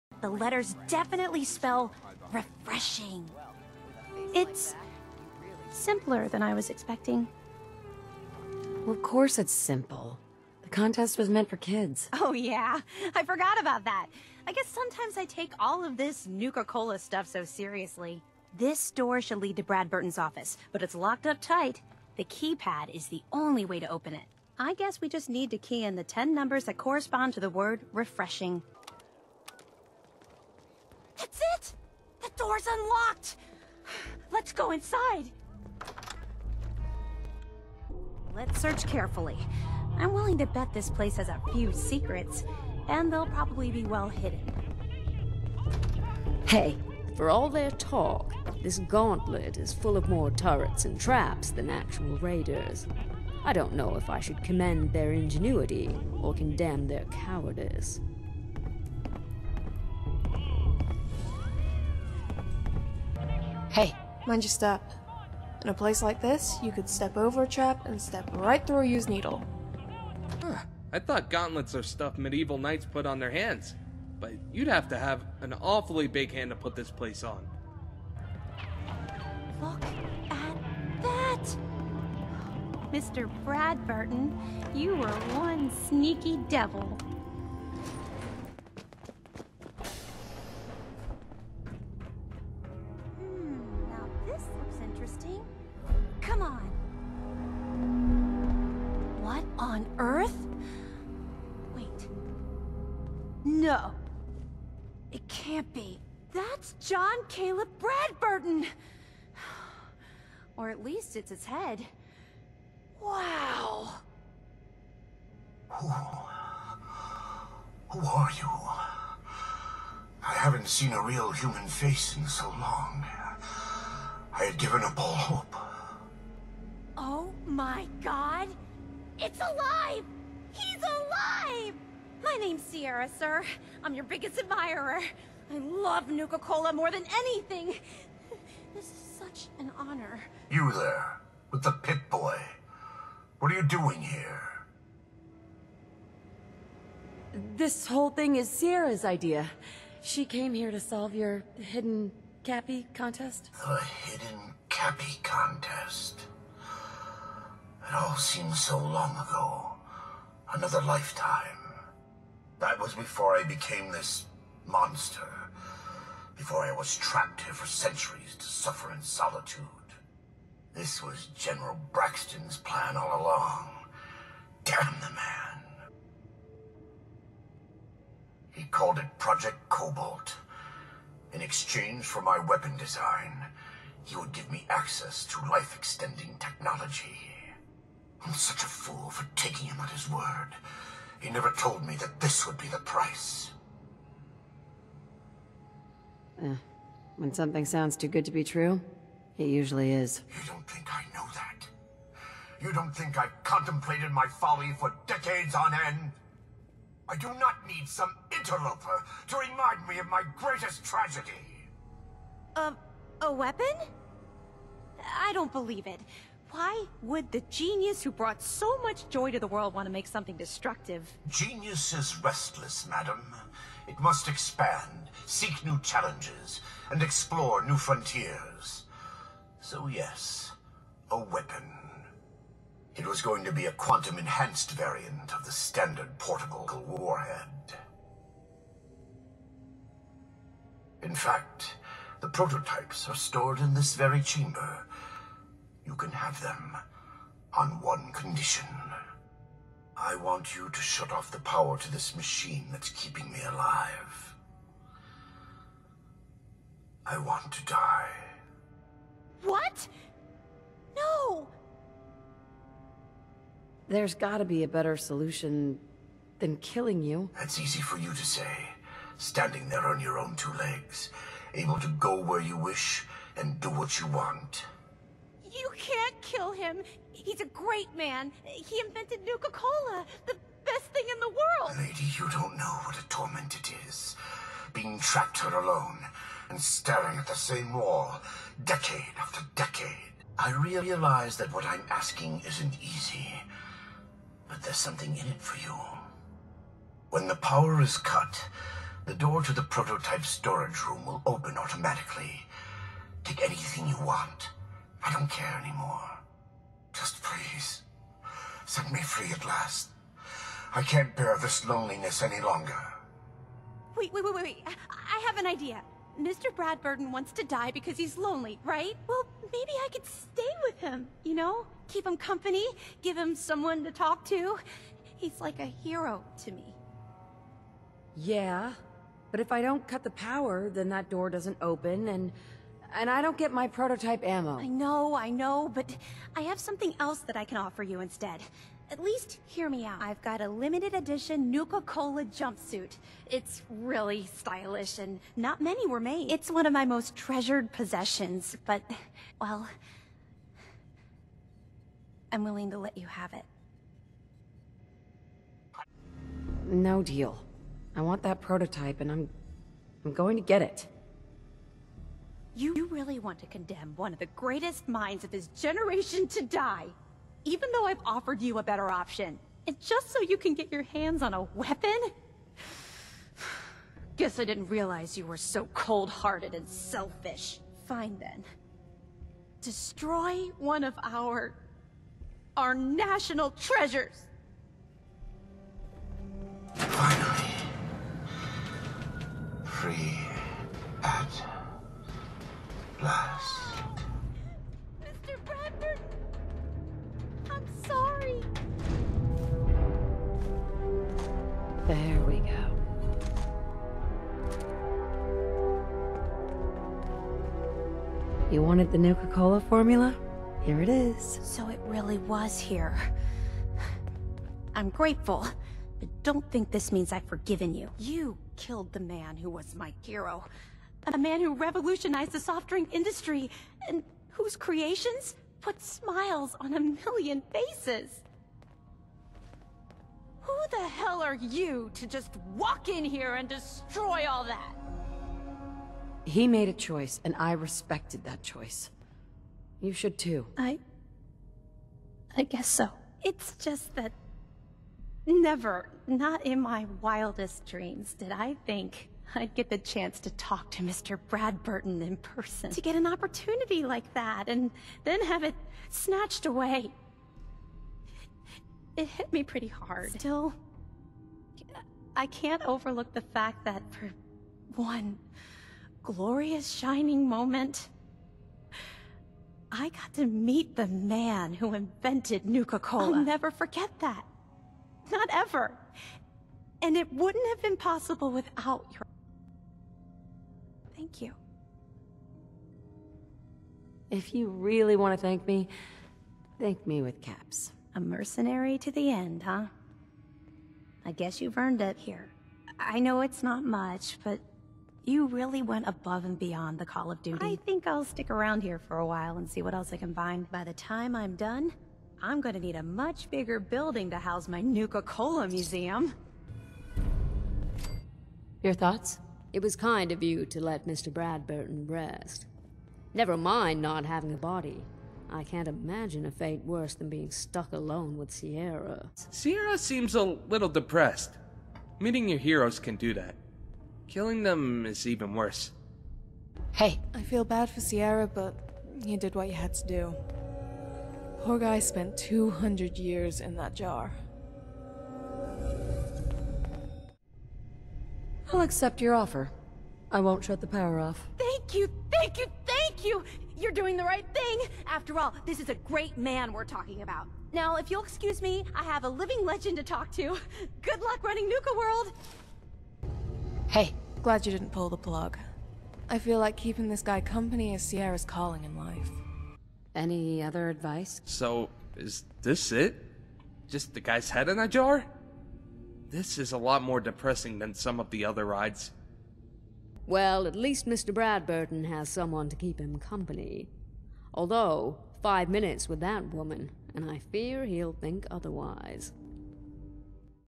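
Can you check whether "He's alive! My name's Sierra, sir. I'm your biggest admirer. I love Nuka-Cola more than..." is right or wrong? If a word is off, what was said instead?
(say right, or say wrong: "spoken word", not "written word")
right.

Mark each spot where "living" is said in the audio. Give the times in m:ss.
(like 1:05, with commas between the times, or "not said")
9:09.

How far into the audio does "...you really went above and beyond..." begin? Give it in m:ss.
8:15.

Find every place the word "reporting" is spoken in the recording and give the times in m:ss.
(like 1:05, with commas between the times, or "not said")
not said.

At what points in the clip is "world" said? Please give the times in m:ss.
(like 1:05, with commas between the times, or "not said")
3:39, 4:41, 9:11.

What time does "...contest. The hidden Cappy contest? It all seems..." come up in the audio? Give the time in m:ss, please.
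2:32.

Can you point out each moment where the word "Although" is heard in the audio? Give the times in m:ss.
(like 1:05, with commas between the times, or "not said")
9:34.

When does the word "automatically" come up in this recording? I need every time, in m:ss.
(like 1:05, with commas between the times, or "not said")
5:01.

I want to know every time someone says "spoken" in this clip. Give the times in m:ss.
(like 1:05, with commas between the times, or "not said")
not said.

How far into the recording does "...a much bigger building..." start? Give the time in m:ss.
8:22.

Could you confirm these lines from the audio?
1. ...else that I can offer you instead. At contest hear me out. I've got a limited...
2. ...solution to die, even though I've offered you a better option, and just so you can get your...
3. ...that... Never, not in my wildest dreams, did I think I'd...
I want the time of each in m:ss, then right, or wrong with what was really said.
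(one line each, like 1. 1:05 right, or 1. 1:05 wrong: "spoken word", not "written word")
1. 5:36 wrong: "least", not "contest"
2. 6:05 wrong: "generation", not "solution"
3. 7:23 right.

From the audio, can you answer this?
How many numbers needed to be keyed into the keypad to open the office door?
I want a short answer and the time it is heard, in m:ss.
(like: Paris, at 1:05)
10, at 0:26.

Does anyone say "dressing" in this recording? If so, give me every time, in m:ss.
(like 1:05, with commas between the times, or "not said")
not said.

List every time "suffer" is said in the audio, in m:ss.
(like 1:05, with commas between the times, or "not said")
2:48.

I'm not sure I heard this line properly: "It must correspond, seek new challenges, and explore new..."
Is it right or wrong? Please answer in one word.
wrong.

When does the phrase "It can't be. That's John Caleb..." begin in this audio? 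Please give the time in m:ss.
1:45.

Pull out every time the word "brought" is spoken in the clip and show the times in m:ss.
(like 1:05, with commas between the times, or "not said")
3:38.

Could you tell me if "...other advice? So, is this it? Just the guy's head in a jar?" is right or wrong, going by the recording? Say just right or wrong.
right.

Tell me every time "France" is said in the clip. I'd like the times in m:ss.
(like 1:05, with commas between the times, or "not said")
not said.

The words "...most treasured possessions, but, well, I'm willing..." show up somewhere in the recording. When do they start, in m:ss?
5:46.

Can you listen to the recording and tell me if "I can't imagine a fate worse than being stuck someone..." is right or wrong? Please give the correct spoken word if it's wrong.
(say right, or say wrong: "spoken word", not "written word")
wrong: "alone", not "someone".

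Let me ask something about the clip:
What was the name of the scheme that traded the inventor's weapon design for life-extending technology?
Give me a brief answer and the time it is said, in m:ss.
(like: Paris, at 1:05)
Project Cobalt, at 2:59.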